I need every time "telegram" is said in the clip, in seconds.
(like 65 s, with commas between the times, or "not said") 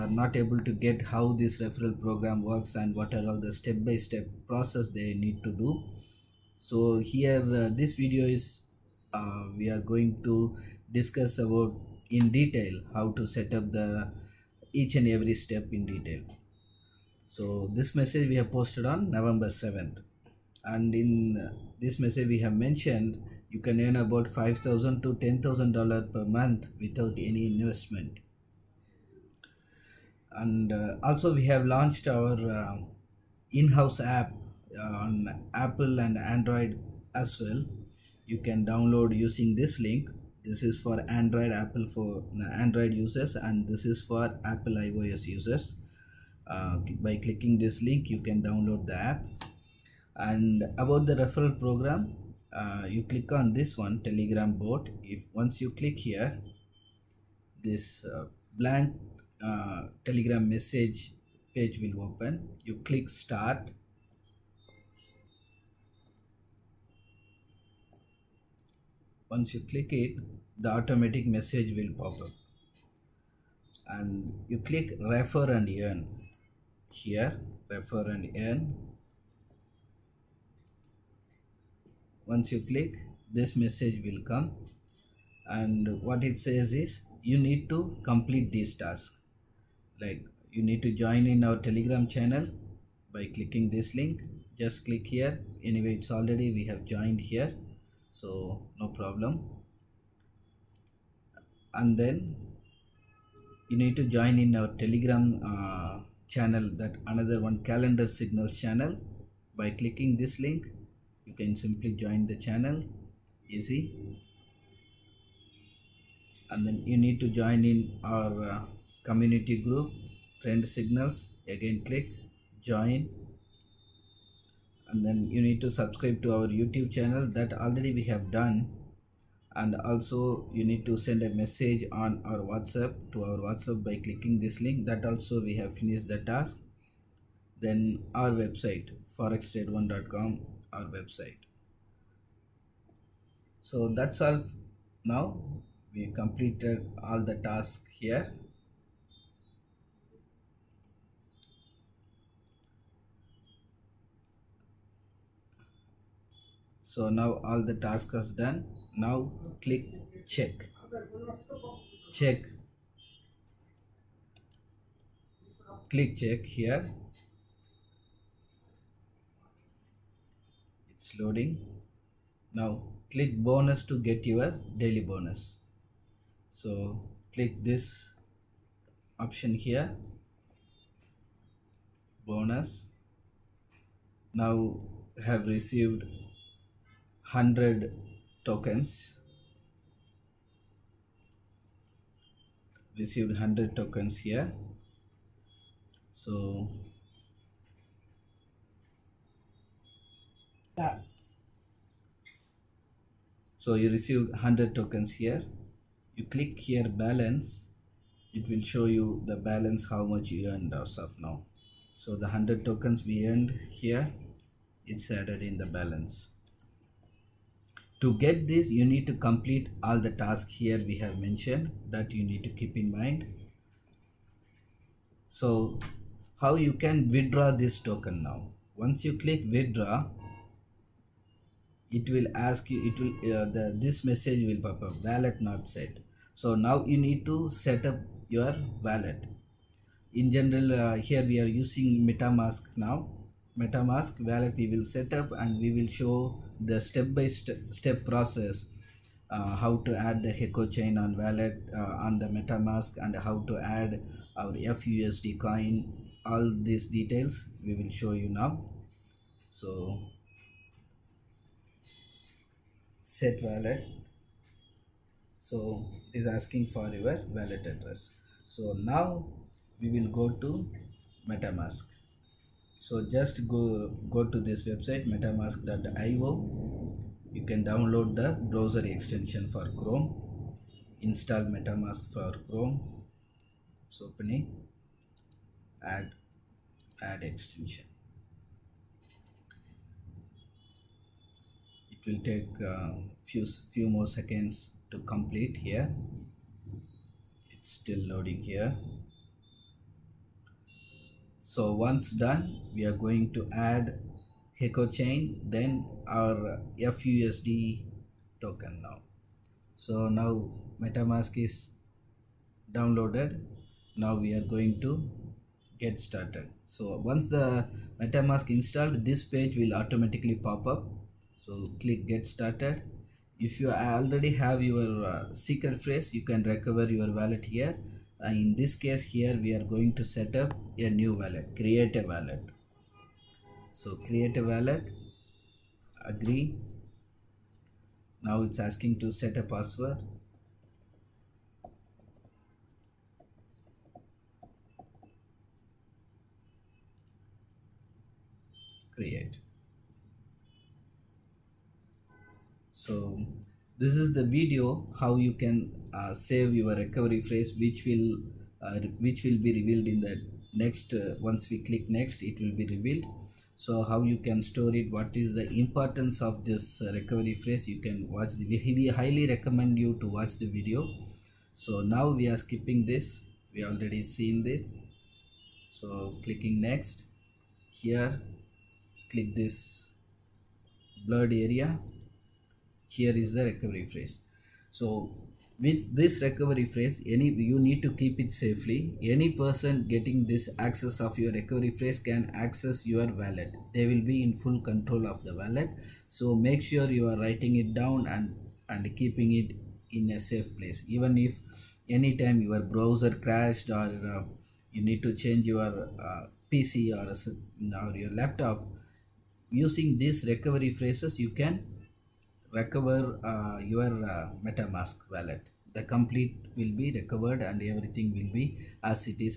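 54 s, 60 s, 91 s, 104 s.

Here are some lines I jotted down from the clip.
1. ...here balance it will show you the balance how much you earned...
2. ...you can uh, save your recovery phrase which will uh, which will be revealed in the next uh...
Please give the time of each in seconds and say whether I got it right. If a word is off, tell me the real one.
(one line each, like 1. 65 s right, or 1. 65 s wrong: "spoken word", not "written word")
1. 206 s right
2. 355 s right.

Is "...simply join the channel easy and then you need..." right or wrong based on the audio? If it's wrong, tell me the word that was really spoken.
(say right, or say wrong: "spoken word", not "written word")
right.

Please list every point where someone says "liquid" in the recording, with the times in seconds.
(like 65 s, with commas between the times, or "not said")
not said.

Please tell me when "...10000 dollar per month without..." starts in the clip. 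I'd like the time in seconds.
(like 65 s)
25 s.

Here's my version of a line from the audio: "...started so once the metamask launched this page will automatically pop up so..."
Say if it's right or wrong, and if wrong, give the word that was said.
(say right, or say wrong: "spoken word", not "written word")
wrong: "installed", not "launched".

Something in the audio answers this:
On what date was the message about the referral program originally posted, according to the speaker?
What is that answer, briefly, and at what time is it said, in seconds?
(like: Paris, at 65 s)
November 7th, at 19 s.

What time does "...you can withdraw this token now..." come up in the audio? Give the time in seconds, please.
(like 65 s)
226 s.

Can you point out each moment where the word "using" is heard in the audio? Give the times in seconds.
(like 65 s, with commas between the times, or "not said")
39 s, 241 s, 409 s.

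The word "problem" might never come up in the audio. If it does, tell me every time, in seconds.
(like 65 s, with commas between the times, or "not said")
98 s.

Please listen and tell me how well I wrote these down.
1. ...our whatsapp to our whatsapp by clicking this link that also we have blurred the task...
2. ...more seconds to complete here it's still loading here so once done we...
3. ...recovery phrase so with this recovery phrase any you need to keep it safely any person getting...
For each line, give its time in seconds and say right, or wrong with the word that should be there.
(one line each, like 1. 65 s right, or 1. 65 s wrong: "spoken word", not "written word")
1. 132 s wrong: "finished", not "blurred"
2. 293 s right
3. 383 s right.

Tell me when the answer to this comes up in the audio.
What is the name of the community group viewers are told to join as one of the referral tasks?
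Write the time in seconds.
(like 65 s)
120 s.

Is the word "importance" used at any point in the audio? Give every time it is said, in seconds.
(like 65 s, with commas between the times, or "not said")
365 s.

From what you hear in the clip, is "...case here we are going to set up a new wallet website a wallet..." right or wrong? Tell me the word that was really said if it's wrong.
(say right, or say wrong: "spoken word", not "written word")
wrong: "create", not "website".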